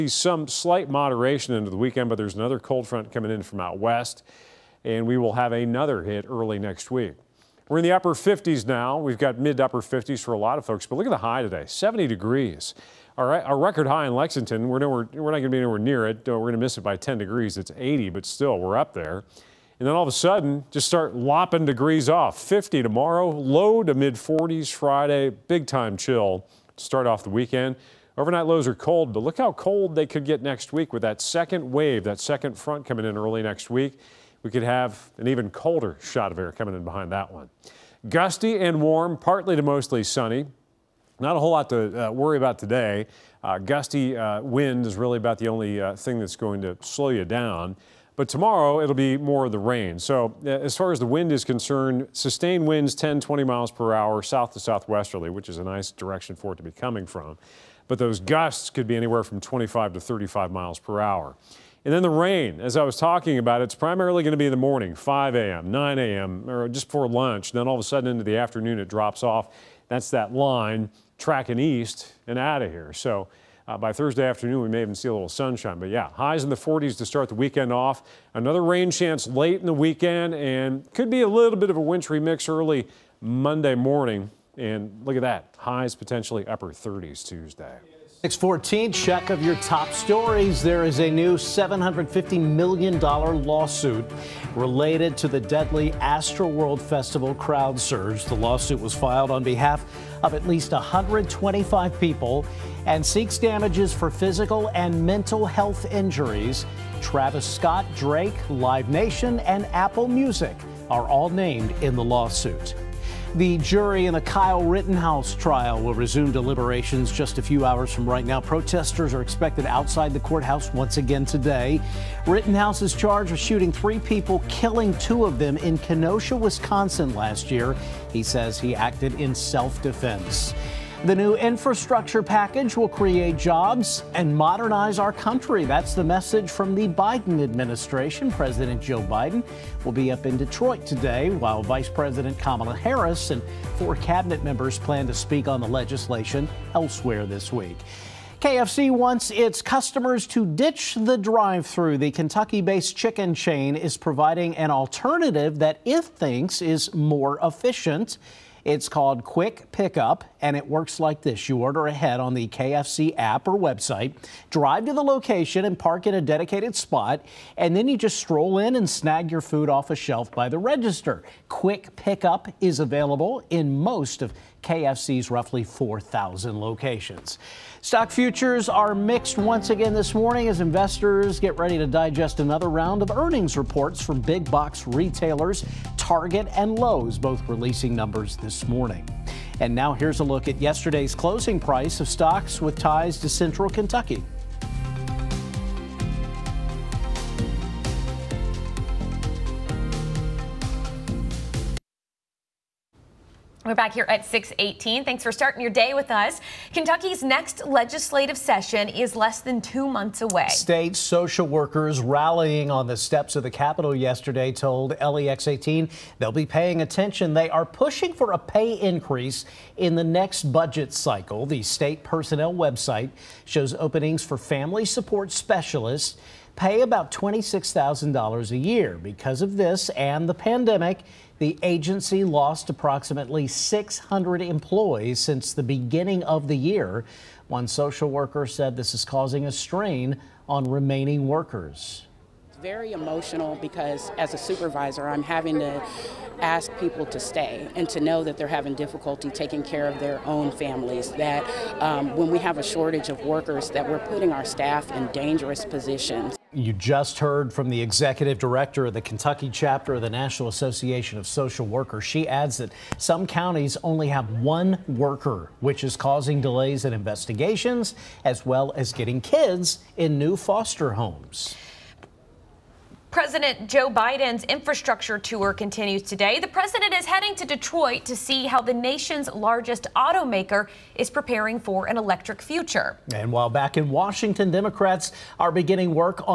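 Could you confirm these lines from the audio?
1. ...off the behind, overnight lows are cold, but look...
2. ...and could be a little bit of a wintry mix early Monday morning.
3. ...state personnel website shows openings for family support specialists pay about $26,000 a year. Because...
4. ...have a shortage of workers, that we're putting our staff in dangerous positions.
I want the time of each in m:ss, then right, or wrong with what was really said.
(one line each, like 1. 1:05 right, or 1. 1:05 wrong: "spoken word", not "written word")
1. 0:27 wrong: "weekend", not "behind"
2. 1:20 right
3. 3:41 right
4. 4:12 right.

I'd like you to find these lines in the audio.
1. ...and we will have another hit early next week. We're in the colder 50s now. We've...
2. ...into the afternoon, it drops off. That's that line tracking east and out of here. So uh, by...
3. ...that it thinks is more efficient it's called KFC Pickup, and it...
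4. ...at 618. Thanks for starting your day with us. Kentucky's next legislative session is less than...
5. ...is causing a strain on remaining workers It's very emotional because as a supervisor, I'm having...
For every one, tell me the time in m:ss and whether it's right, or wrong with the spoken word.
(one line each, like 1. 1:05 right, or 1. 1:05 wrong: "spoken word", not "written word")
1. 0:04 wrong: "upper", not "colder"
2. 1:08 right
3. 2:35 wrong: "Quick", not "KFC"
4. 3:24 right
5. 3:58 right.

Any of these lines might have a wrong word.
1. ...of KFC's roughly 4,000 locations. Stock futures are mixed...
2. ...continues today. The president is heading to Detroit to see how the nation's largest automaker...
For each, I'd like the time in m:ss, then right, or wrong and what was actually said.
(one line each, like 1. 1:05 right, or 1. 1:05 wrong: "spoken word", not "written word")
1. 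2:54 right
2. 4:35 right.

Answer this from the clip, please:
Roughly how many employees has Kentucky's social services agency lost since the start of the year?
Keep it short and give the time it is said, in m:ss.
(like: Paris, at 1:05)
600, at 3:53.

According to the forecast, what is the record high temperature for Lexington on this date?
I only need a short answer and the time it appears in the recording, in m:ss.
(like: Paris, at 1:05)
80, at 0:17.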